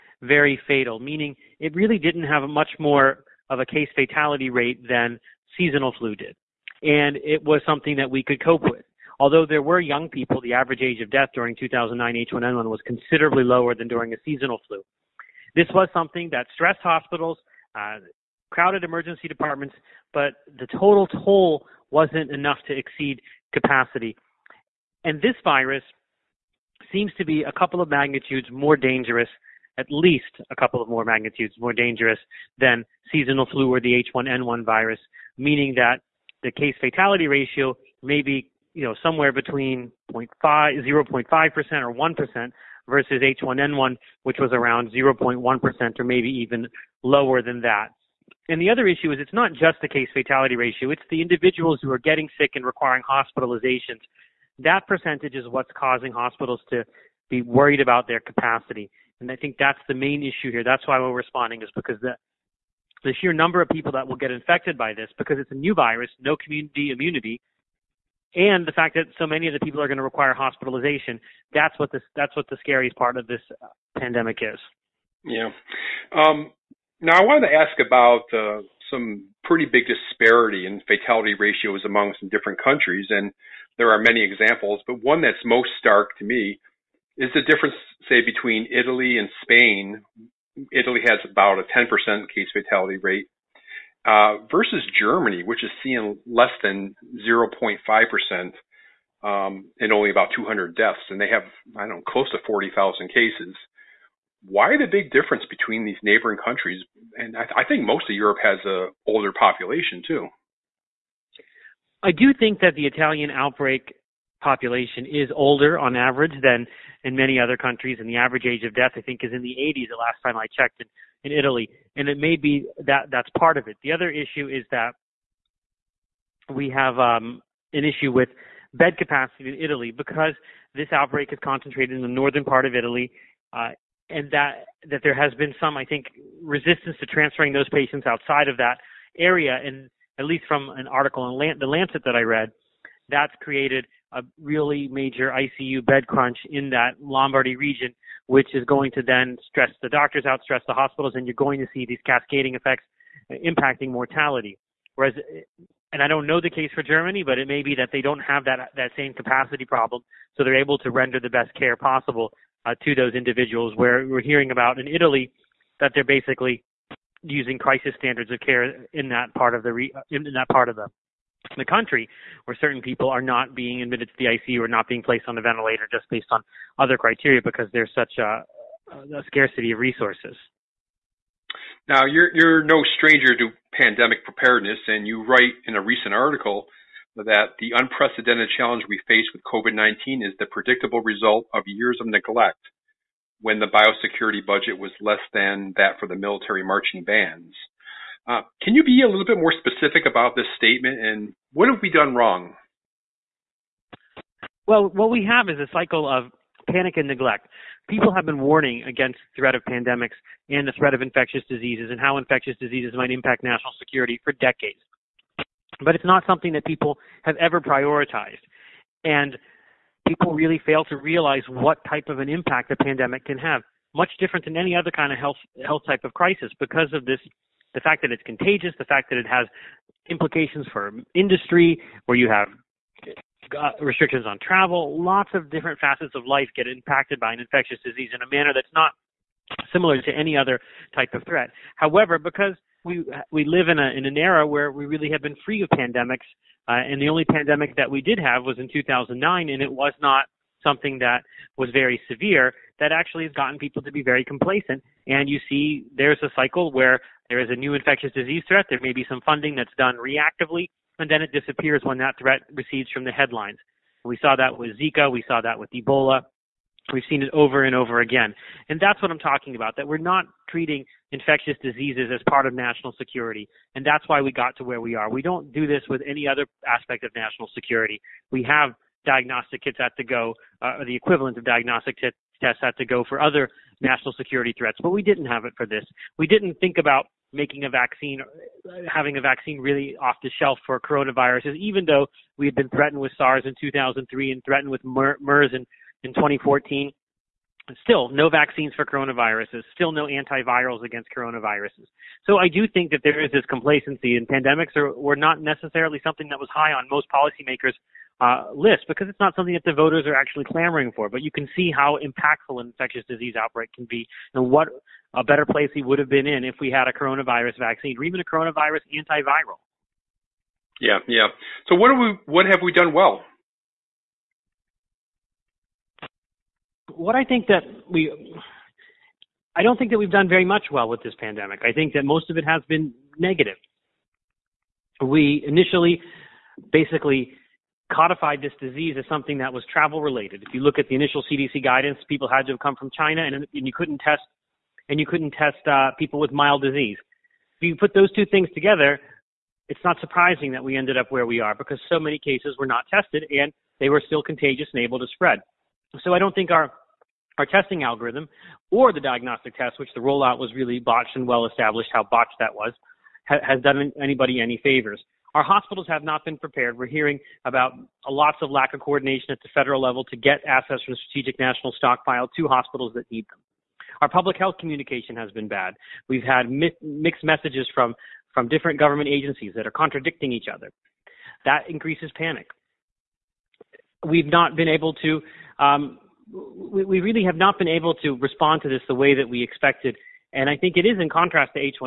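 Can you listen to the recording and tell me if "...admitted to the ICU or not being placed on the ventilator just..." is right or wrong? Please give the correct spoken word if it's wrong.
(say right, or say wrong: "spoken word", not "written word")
right.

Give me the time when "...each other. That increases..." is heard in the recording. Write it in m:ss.
6:20.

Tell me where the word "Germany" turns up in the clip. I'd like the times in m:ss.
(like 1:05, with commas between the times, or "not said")
1:34, 2:36.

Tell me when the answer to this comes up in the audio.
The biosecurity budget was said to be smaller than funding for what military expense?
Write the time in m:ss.
3:16.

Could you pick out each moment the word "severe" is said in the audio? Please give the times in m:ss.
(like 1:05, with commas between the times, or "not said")
4:12.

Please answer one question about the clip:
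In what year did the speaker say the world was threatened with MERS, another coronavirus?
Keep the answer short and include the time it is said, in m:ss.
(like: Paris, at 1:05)
2014, at 4:56.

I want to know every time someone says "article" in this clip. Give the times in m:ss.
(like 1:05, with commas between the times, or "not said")
2:20, 3:06.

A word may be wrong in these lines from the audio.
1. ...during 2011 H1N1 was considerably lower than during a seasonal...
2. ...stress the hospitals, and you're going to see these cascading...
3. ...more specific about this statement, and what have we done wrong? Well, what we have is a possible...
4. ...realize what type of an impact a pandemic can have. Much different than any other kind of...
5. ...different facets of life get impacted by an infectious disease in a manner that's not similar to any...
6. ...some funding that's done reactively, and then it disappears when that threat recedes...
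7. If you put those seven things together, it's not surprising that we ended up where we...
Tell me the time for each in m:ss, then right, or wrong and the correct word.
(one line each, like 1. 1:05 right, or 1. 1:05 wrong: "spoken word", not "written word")
1. 0:11 wrong: "2009", not "2011"
2. 2:30 right
3. 3:19 wrong: "cycle", not "possible"
4. 3:40 right
5. 3:55 right
6. 4:19 right
7. 5:47 wrong: "two", not "seven".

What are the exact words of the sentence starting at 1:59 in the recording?
The last time I checked, and in Italy, and it may be that that's part of it.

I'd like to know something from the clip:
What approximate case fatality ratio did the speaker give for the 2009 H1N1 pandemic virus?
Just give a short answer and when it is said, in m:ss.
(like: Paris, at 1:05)
0.1%, at 0:44.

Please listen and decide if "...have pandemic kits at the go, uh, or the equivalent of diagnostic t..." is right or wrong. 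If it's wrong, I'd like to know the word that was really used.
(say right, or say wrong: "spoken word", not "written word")
wrong: "diagnostic", not "pandemic".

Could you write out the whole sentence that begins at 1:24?
But one that's most stark to me is the difference, say, between Italy and Spain.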